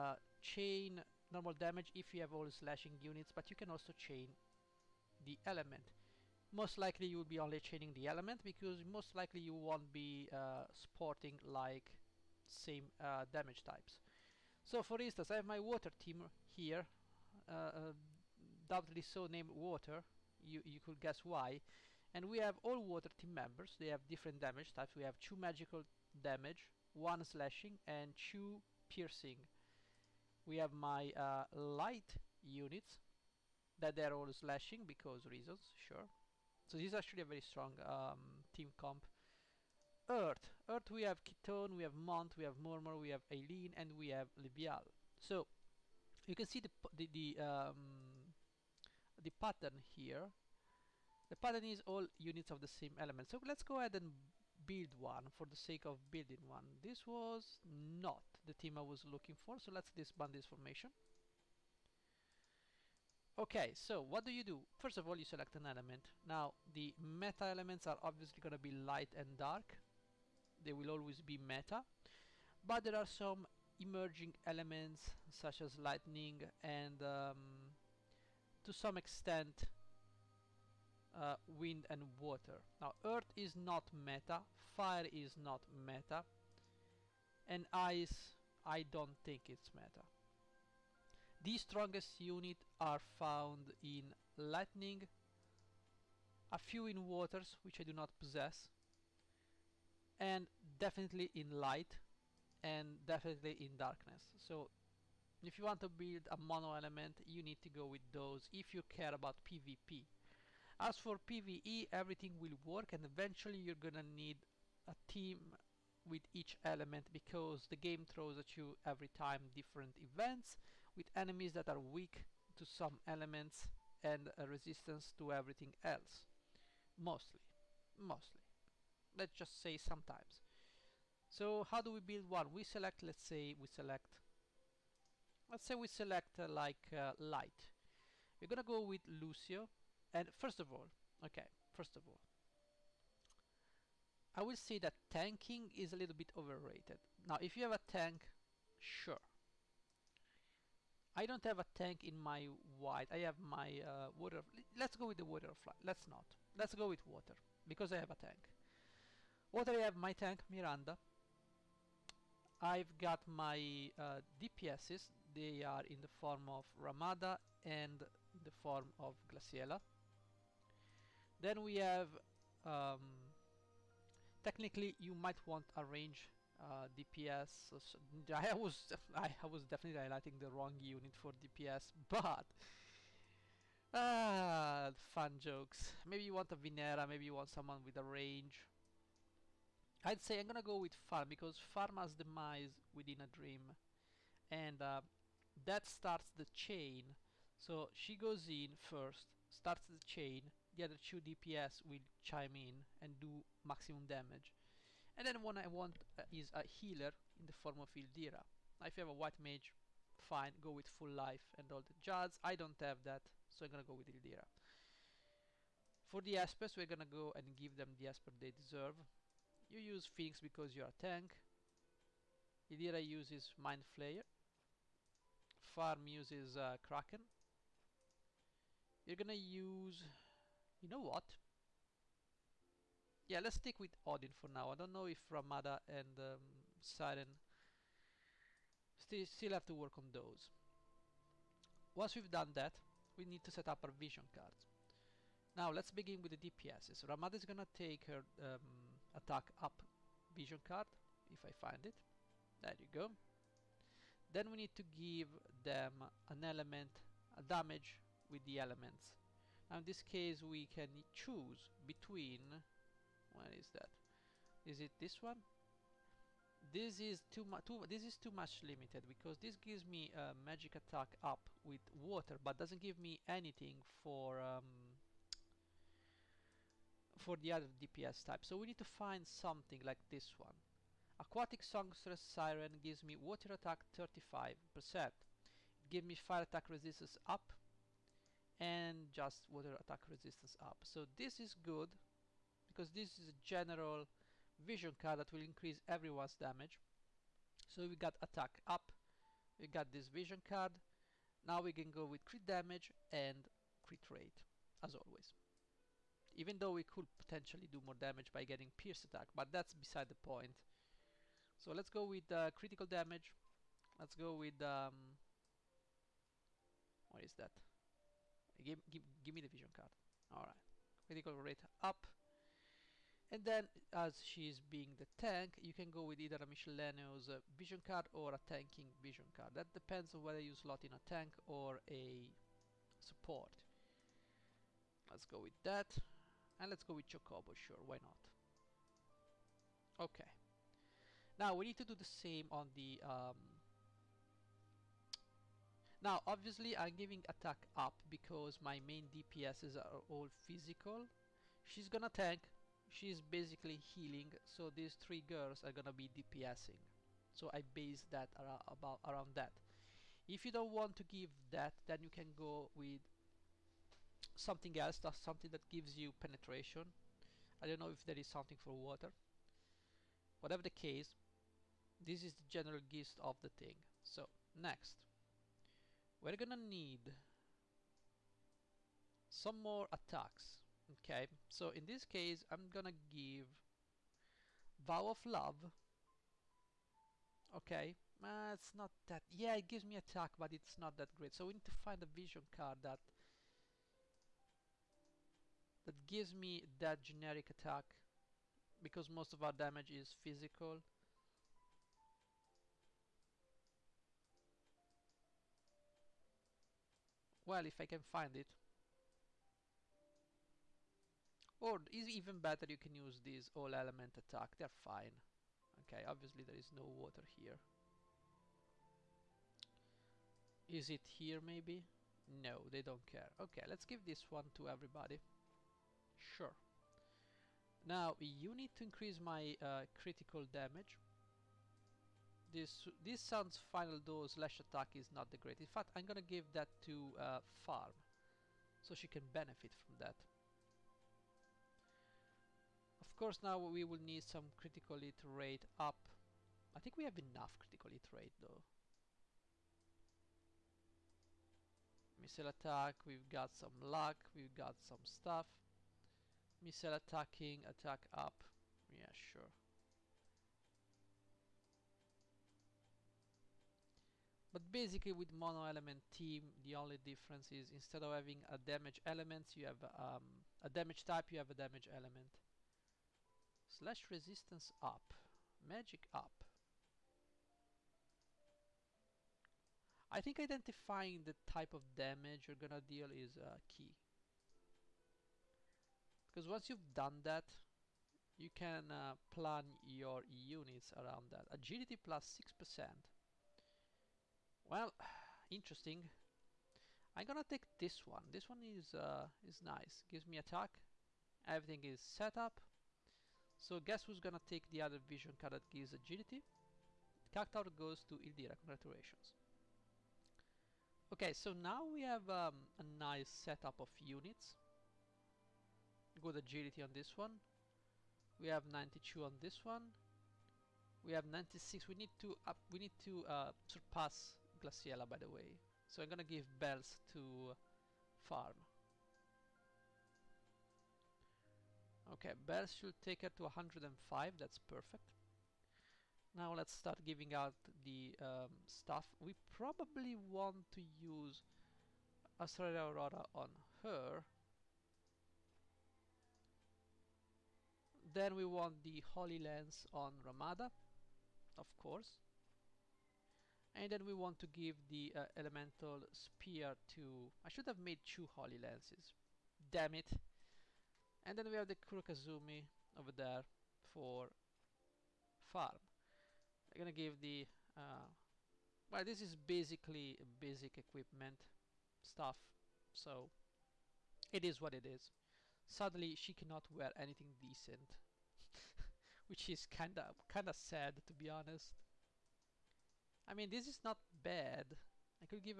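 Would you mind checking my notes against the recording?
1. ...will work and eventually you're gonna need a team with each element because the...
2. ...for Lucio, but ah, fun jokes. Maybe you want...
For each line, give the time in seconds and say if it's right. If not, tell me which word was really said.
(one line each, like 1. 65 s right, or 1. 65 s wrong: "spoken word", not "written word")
1. 112 s right
2. 181 s wrong: "DPS", not "Lucio".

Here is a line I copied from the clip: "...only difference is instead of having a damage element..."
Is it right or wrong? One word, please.
right.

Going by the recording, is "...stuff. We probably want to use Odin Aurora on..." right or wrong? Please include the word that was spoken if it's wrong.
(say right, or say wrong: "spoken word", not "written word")
wrong: "Australia", not "Odin".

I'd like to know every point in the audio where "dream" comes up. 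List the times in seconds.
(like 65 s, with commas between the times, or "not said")
193 s.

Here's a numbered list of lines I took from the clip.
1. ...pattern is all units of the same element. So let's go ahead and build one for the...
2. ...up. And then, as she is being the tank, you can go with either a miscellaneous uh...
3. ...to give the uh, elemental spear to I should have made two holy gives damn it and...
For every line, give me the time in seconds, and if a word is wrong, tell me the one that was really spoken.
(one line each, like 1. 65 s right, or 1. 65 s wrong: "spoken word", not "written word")
1. 51 s right
2. 321 s right
3. 554 s wrong: "lances", not "gives".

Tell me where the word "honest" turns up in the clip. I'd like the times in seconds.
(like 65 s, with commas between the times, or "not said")
581 s.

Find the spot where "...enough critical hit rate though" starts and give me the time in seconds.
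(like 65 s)
447 s.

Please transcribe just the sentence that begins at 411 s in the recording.
Or is even better you can use these all element attack, they're fine.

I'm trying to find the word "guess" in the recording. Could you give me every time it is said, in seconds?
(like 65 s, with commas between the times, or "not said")
20 s, 503 s.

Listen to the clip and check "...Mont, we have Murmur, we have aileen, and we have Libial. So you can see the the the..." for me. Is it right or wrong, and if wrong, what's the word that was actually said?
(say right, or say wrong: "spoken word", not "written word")
right.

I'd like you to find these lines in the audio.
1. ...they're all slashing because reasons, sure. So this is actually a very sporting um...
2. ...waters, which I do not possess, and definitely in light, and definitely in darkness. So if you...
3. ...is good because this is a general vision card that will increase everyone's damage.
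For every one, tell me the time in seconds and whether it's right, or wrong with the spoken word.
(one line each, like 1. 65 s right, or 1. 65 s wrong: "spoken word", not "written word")
1. 33 s wrong: "strong", not "sporting"
2. 97 s right
3. 291 s right.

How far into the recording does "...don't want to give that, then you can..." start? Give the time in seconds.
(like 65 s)
360 s.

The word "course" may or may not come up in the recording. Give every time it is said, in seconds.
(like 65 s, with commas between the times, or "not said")
443 s, 551 s.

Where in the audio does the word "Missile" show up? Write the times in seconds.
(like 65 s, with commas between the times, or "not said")
452 s, 456 s.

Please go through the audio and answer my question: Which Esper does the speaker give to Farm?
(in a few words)
Kraken.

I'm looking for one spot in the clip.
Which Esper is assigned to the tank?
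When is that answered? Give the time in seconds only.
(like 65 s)
220 s.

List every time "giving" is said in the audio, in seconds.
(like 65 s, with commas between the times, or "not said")
346 s, 537 s.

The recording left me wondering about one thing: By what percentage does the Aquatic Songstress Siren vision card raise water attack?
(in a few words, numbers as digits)
35 percent.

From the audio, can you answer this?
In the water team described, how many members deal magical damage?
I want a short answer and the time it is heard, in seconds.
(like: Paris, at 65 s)
2, at 25 s.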